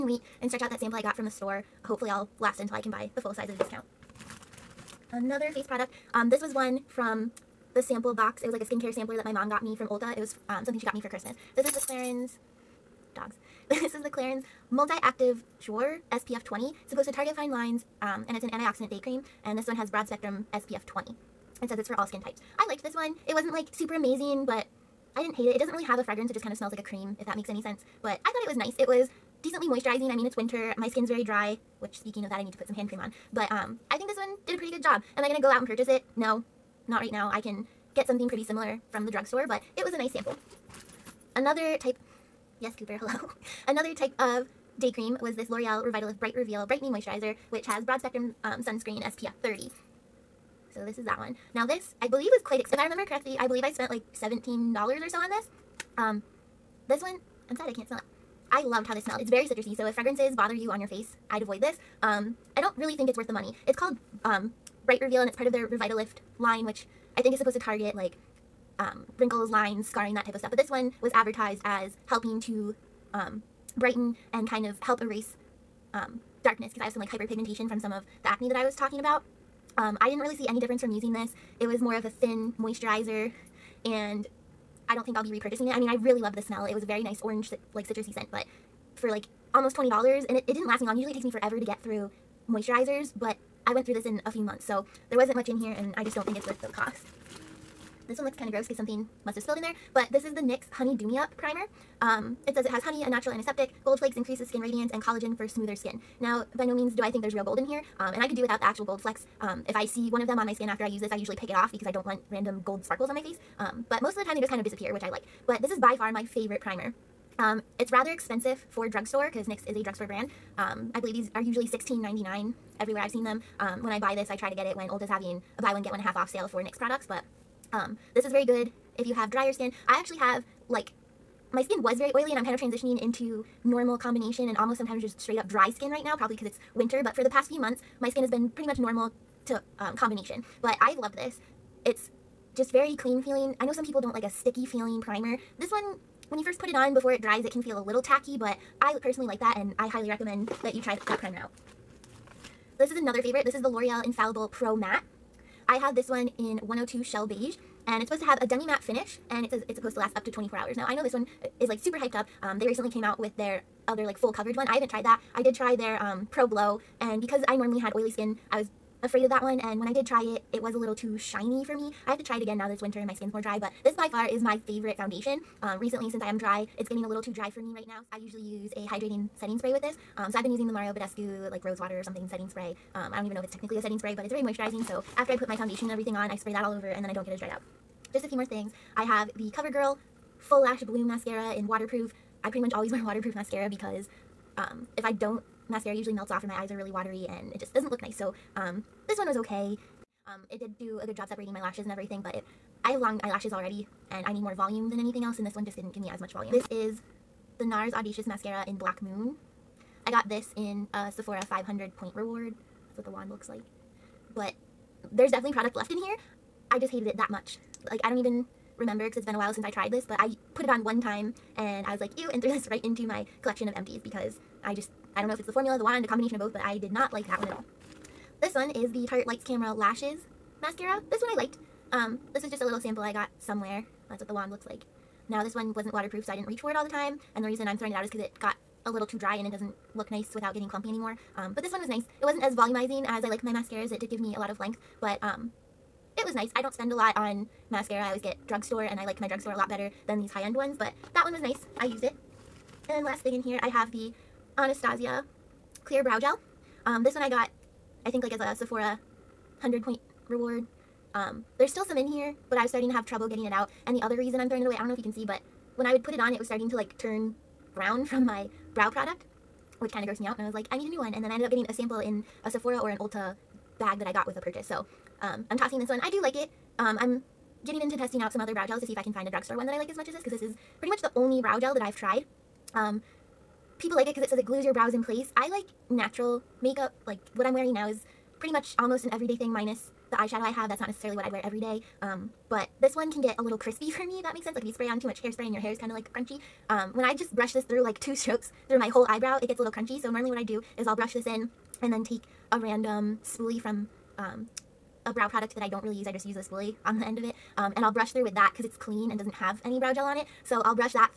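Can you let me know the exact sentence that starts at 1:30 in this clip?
Usually it takes me forever to get through moisturizers, but I went through this in a few months.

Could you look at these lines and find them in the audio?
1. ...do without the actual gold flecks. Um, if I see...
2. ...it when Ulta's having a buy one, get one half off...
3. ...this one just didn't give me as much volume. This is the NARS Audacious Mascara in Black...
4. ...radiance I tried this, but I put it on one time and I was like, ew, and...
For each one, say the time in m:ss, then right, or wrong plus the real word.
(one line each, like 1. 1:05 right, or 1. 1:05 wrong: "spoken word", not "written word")
1. 1:48 right
2. 2:04 right
3. 3:25 right
4. 3:39 wrong: "since", not "radiance".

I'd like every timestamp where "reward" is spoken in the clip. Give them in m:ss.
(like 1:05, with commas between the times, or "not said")
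3:32, 4:20.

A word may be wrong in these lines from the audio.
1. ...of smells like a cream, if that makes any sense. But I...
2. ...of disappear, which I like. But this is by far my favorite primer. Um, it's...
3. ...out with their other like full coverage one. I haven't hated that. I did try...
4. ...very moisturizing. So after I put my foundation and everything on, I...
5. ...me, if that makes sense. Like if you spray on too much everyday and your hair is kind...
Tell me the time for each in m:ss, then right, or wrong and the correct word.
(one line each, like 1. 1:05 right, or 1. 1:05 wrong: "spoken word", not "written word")
1. 0:26 right
2. 1:54 right
3. 2:43 wrong: "tried", not "hated"
4. 3:04 right
5. 4:54 wrong: "hairspray", not "everyday".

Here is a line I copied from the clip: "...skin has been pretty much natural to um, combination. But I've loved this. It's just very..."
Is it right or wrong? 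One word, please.
wrong.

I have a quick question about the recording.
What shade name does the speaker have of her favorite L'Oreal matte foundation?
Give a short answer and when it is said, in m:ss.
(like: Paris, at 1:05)
102 Shell Beige, at 2:36.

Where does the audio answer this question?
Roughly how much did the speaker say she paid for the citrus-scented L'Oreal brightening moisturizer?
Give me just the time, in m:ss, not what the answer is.
0:54.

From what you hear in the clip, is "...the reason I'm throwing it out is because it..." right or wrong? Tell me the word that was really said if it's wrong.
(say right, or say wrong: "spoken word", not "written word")
right.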